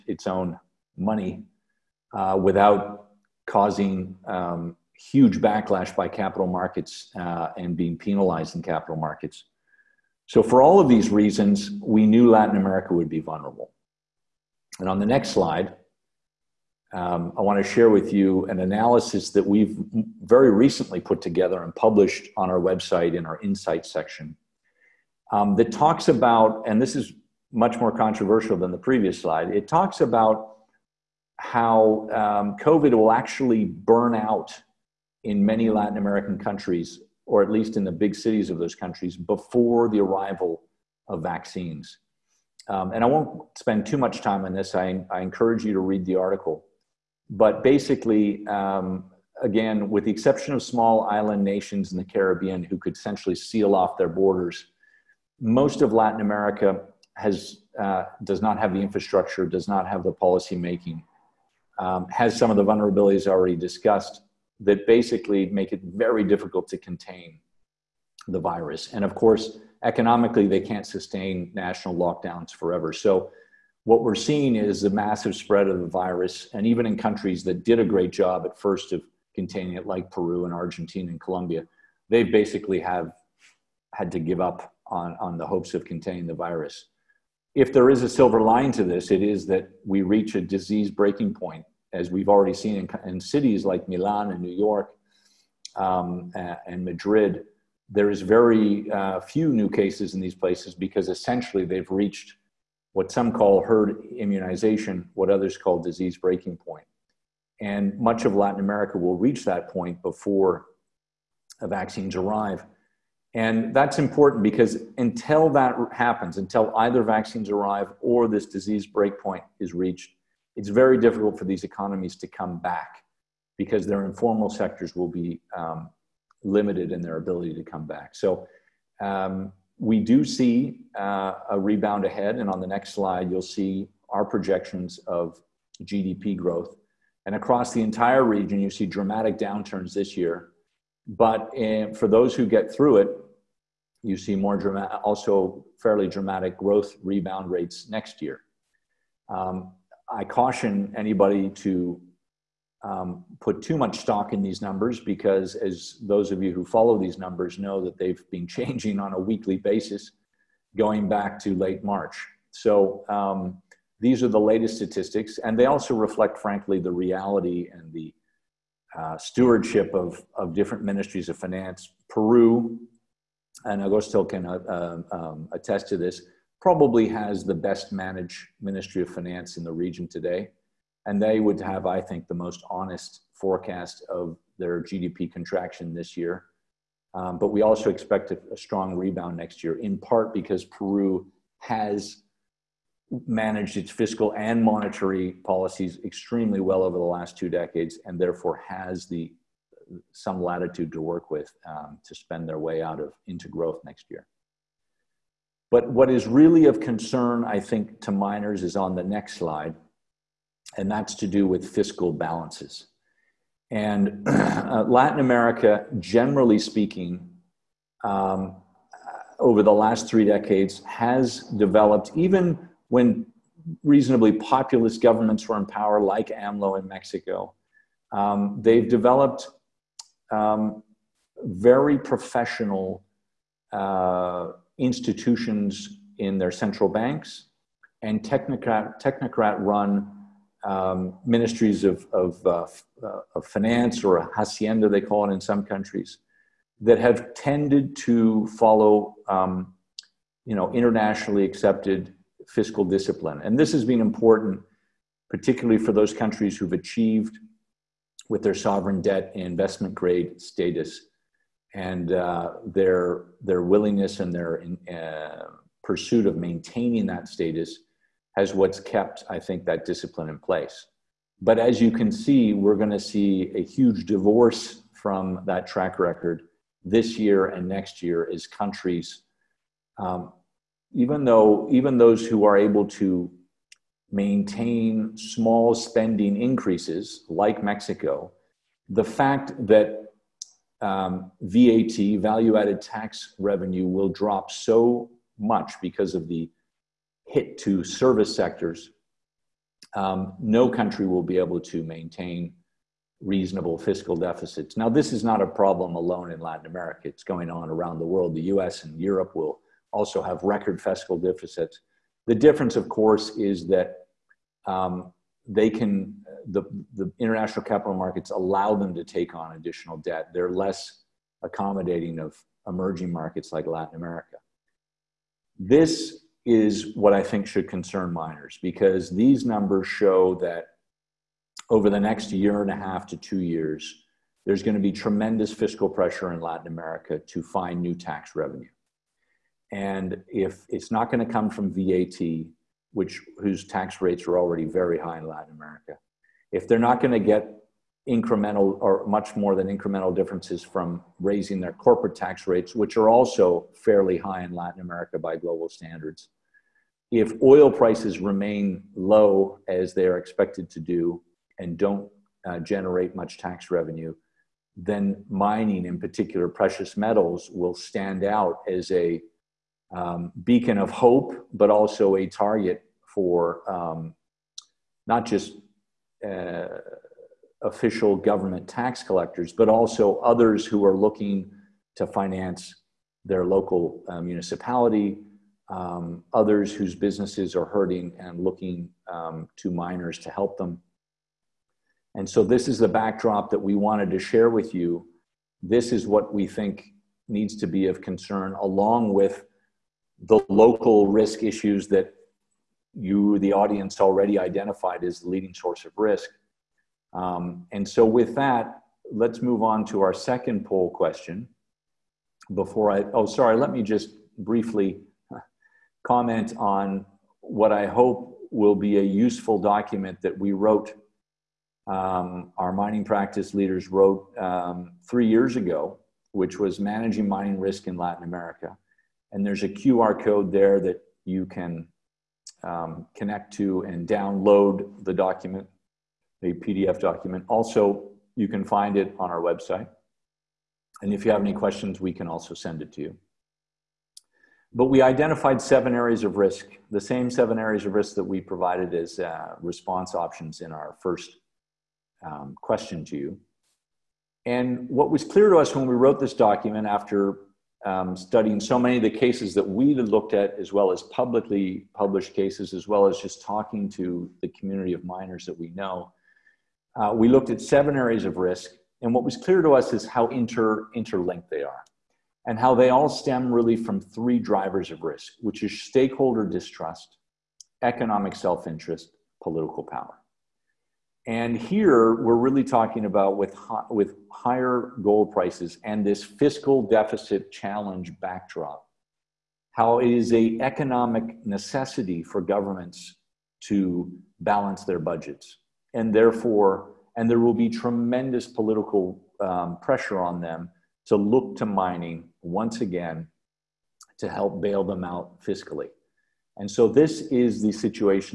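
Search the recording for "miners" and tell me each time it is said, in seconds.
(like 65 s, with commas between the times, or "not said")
208 s, 328 s, 389 s, 465 s.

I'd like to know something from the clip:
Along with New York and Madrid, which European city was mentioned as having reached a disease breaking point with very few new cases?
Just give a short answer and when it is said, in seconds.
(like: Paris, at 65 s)
Milan, at 93 s.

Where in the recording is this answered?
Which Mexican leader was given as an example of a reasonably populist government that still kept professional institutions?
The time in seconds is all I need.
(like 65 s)
226 s.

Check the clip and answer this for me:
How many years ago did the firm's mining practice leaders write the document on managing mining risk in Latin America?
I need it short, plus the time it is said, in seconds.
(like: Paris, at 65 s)
3 years, at 425 s.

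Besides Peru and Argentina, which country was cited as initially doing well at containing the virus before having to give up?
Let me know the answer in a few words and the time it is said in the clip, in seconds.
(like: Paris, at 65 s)
Colombia, at 81 s.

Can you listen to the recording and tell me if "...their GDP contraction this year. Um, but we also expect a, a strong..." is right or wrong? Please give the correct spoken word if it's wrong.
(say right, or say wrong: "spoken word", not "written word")
right.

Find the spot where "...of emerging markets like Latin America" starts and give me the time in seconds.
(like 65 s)
322 s.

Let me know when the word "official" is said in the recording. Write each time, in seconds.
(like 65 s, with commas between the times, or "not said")
377 s.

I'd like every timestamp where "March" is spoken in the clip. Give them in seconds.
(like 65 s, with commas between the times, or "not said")
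161 s.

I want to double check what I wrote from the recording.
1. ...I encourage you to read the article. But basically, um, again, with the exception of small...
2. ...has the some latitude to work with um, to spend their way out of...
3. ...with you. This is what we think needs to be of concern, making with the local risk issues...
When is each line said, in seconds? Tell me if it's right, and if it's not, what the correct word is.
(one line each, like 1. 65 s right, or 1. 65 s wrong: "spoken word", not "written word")
1. 45 s right
2. 198 s right
3. 394 s wrong: "along", not "making".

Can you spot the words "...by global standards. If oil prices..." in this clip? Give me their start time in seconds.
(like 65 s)
355 s.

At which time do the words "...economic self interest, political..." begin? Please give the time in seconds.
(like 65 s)
477 s.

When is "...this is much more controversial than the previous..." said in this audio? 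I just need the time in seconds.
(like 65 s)
26 s.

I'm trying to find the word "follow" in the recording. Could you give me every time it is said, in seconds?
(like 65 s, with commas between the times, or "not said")
156 s, 248 s.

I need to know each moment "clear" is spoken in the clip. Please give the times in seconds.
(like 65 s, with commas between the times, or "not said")
455 s, 469 s.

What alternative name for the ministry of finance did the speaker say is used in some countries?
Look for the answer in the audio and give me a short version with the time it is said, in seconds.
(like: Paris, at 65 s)
hacienda, at 244 s.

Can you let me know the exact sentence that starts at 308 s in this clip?
The US and Europe will also have record fiscal deficits.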